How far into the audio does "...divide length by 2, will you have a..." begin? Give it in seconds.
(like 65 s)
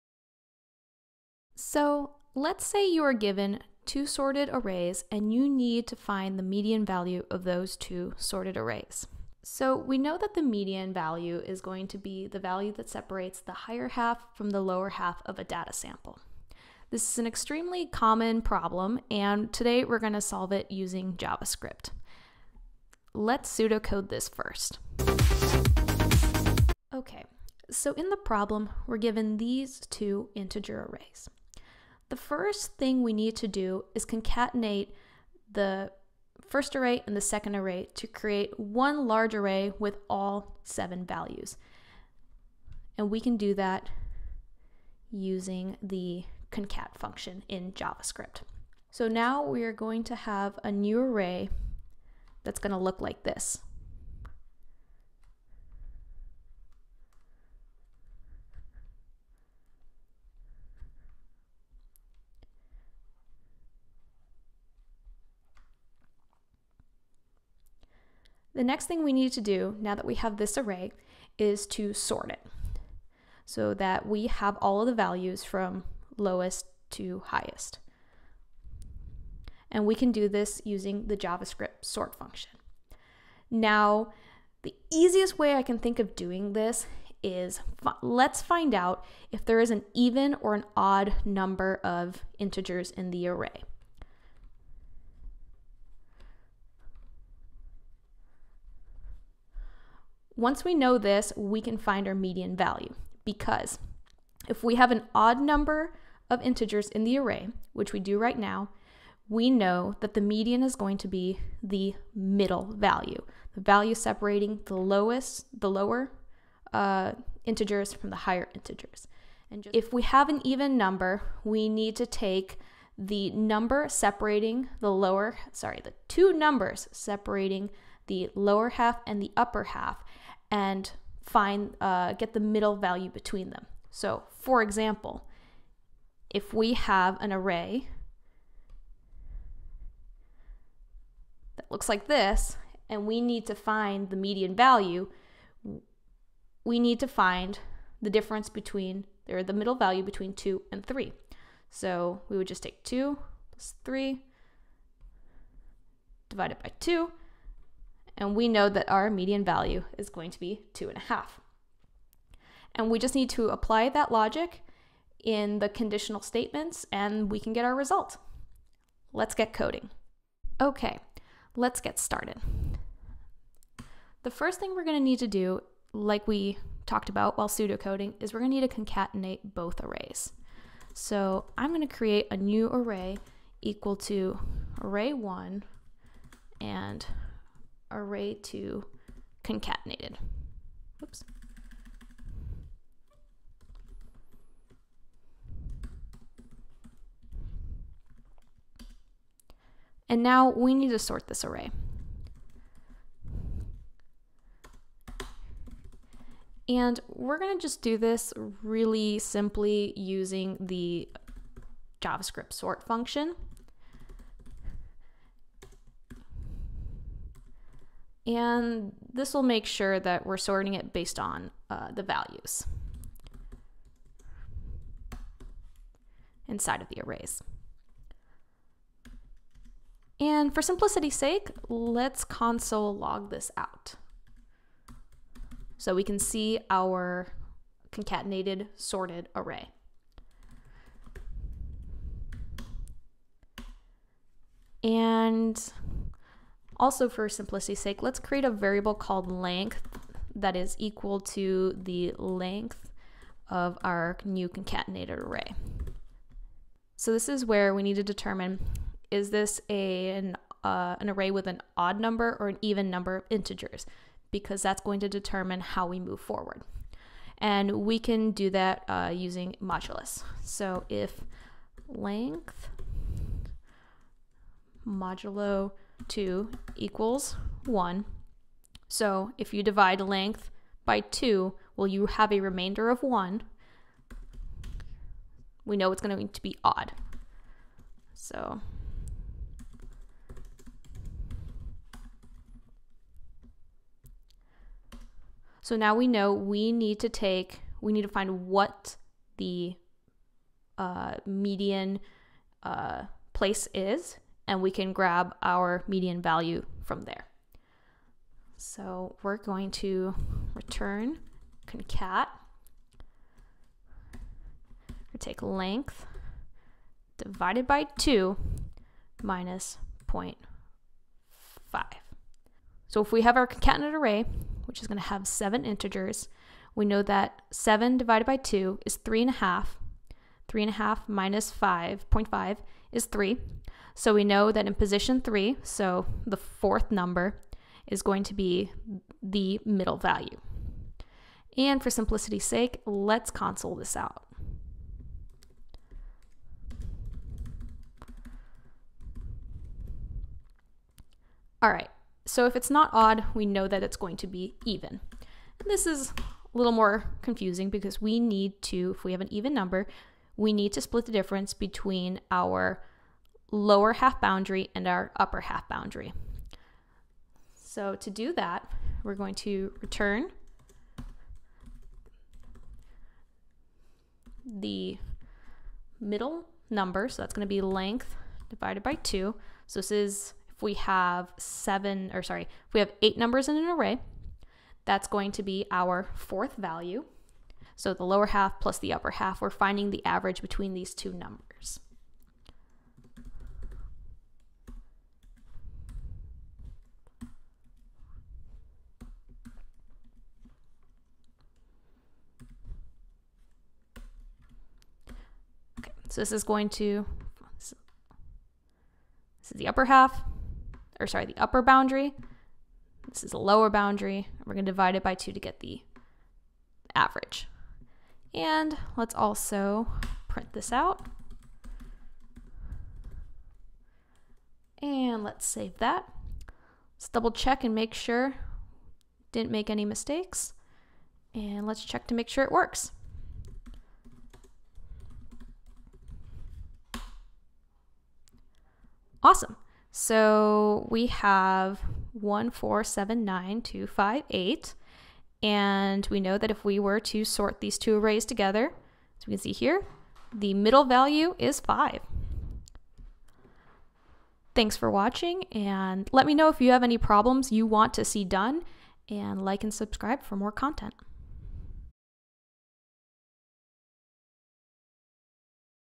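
279 s.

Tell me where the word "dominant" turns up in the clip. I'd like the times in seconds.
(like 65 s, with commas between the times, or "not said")
not said.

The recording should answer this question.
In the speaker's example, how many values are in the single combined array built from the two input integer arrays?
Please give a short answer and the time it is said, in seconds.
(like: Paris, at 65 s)
7, at 40 s.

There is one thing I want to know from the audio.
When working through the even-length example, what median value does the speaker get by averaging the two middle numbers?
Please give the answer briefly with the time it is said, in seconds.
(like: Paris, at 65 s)
2.5, at 160 s.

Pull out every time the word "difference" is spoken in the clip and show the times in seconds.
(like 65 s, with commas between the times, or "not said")
148 s, 361 s.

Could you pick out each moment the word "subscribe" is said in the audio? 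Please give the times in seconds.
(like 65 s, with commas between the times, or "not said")
459 s.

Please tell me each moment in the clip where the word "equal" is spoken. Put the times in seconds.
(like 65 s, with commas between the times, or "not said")
183 s, 250 s, 276 s.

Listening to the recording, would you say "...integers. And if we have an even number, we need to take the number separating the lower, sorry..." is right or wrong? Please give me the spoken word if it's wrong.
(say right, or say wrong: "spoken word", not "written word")
right.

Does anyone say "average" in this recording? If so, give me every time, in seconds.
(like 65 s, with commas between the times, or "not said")
390 s, 416 s.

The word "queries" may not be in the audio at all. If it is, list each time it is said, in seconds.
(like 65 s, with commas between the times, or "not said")
not said.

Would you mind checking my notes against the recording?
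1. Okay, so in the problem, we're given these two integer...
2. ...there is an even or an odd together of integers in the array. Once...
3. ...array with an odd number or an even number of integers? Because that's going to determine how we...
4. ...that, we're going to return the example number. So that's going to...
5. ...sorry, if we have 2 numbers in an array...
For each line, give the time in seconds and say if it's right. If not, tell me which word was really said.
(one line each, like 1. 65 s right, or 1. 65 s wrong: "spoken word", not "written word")
1. 26 s right
2. 89 s wrong: "number", not "together"
3. 261 s right
4. 368 s wrong: "middle", not "example"
5. 382 s wrong: "8", not "2".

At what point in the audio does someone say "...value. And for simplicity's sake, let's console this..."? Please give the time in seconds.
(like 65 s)
339 s.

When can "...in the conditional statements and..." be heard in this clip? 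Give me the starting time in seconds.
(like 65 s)
165 s.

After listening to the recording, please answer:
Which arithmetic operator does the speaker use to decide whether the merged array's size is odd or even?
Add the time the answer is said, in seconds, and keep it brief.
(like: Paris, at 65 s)
modulus, at 269 s.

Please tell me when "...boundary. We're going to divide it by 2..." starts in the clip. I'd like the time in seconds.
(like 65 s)
413 s.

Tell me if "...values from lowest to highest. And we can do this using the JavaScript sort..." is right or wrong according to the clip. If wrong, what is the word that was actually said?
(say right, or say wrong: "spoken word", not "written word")
right.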